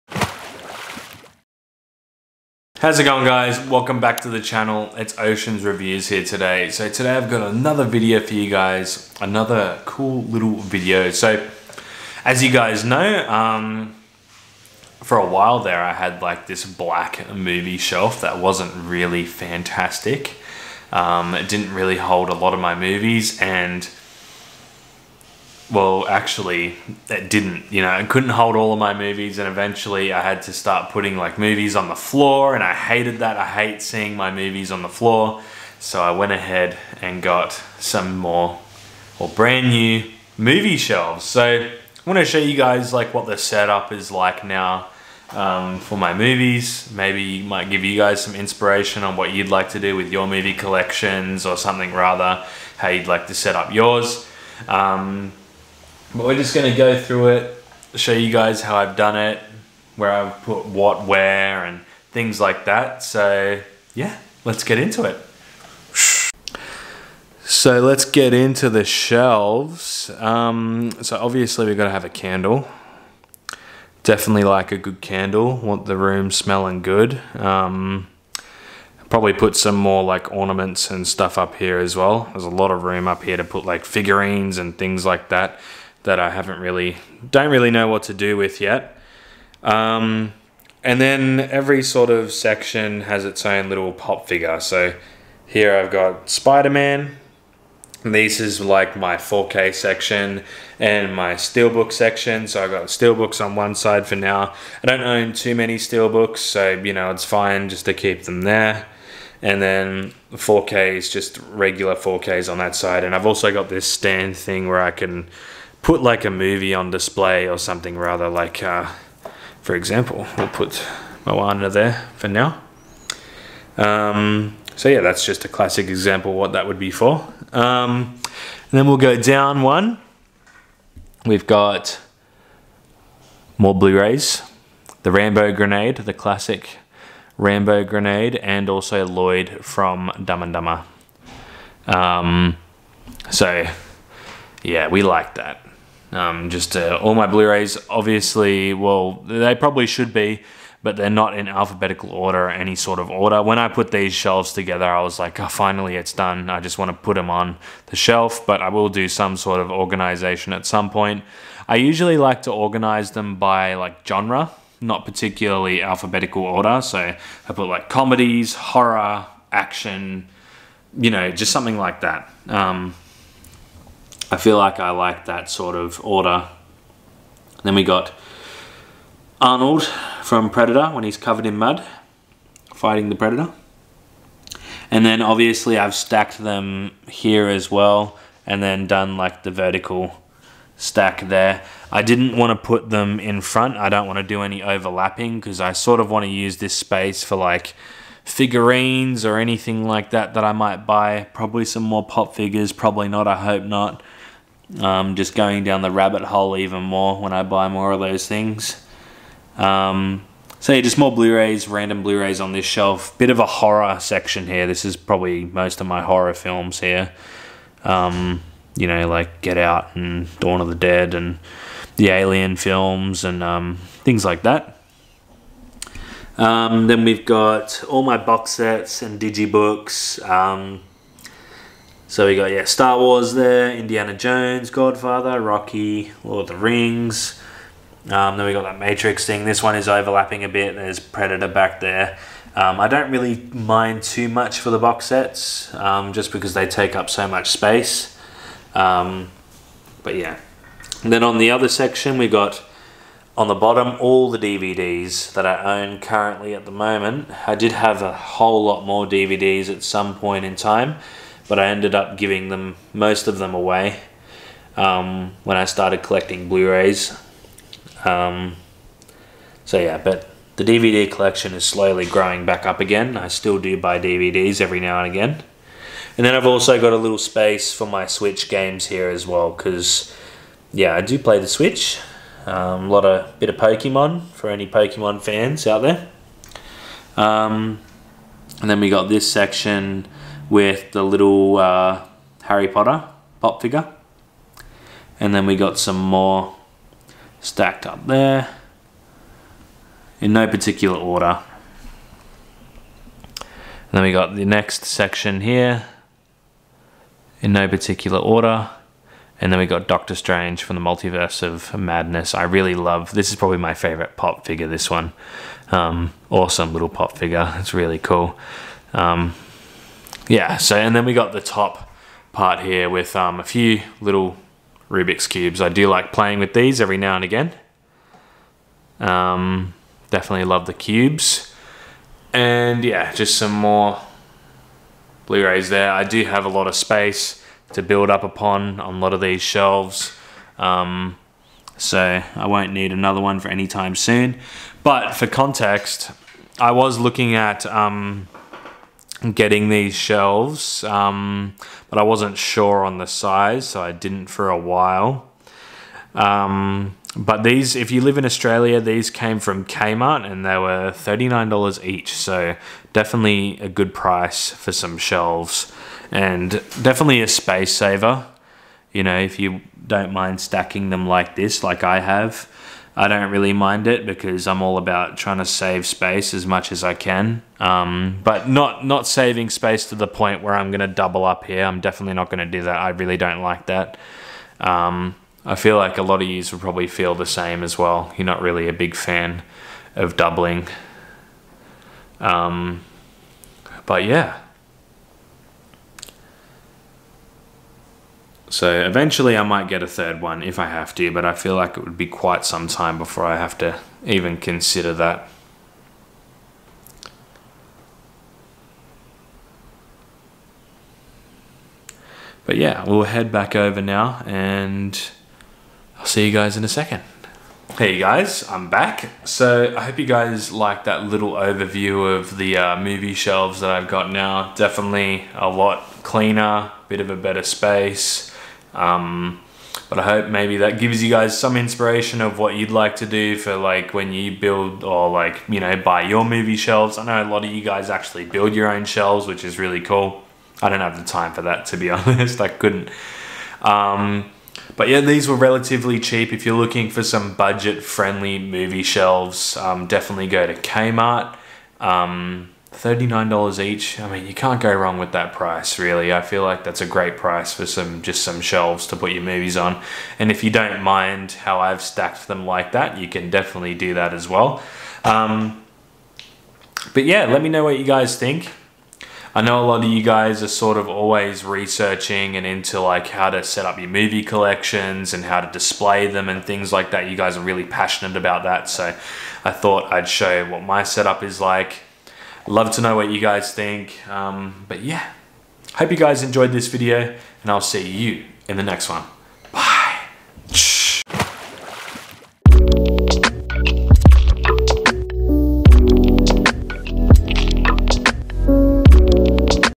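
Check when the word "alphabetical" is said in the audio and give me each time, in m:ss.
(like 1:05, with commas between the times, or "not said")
2:31, 2:45.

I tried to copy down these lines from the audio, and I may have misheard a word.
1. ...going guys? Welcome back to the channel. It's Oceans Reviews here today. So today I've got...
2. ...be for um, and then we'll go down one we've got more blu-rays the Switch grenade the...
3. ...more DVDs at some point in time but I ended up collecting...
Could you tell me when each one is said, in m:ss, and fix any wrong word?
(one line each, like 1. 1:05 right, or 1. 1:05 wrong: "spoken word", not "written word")
1. 0:03 right
2. 2:06 wrong: "Rambo", not "Switch"
3. 4:18 wrong: "giving", not "collecting".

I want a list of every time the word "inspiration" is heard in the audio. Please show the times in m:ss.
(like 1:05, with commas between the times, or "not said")
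0:48, 7:11.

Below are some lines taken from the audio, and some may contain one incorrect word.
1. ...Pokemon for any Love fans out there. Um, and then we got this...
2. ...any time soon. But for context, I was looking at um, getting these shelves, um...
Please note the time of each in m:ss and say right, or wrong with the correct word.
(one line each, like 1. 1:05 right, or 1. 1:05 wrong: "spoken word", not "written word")
1. 4:43 wrong: "Pokemon", not "Love"
2. 5:43 right.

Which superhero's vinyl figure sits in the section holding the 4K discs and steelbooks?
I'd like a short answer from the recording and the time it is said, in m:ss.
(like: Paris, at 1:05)
Spider-Man, at 1:36.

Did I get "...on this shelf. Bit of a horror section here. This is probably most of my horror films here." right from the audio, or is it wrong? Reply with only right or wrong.
right.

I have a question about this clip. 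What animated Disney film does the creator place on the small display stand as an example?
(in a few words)
Moana.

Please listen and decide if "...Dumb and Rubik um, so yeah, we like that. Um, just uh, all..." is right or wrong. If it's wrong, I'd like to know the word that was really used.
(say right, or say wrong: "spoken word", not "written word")
wrong: "Dumber", not "Rubik".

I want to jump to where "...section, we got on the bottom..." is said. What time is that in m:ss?
4:11.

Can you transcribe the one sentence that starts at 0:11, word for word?
So as you guys know, um, for a while there I had like this black movie shelf that wasn't really fantastic.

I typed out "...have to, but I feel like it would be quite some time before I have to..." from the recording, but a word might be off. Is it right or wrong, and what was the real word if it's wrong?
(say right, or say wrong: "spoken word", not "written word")
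right.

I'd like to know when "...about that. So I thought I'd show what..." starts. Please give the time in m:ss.
7:58.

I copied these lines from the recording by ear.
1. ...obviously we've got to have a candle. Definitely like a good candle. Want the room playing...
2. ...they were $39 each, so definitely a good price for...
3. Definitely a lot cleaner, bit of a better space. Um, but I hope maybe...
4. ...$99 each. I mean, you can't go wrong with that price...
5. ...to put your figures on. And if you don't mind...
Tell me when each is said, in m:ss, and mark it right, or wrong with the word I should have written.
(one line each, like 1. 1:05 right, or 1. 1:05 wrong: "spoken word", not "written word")
1. 1:11 wrong: "smelling", not "playing"
2. 6:00 right
3. 7:04 right
4. 7:32 wrong: "39", not "99"
5. 7:38 wrong: "movies", not "figures".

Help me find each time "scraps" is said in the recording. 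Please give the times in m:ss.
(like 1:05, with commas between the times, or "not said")
not said.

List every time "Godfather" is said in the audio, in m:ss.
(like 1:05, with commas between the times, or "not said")
3:54.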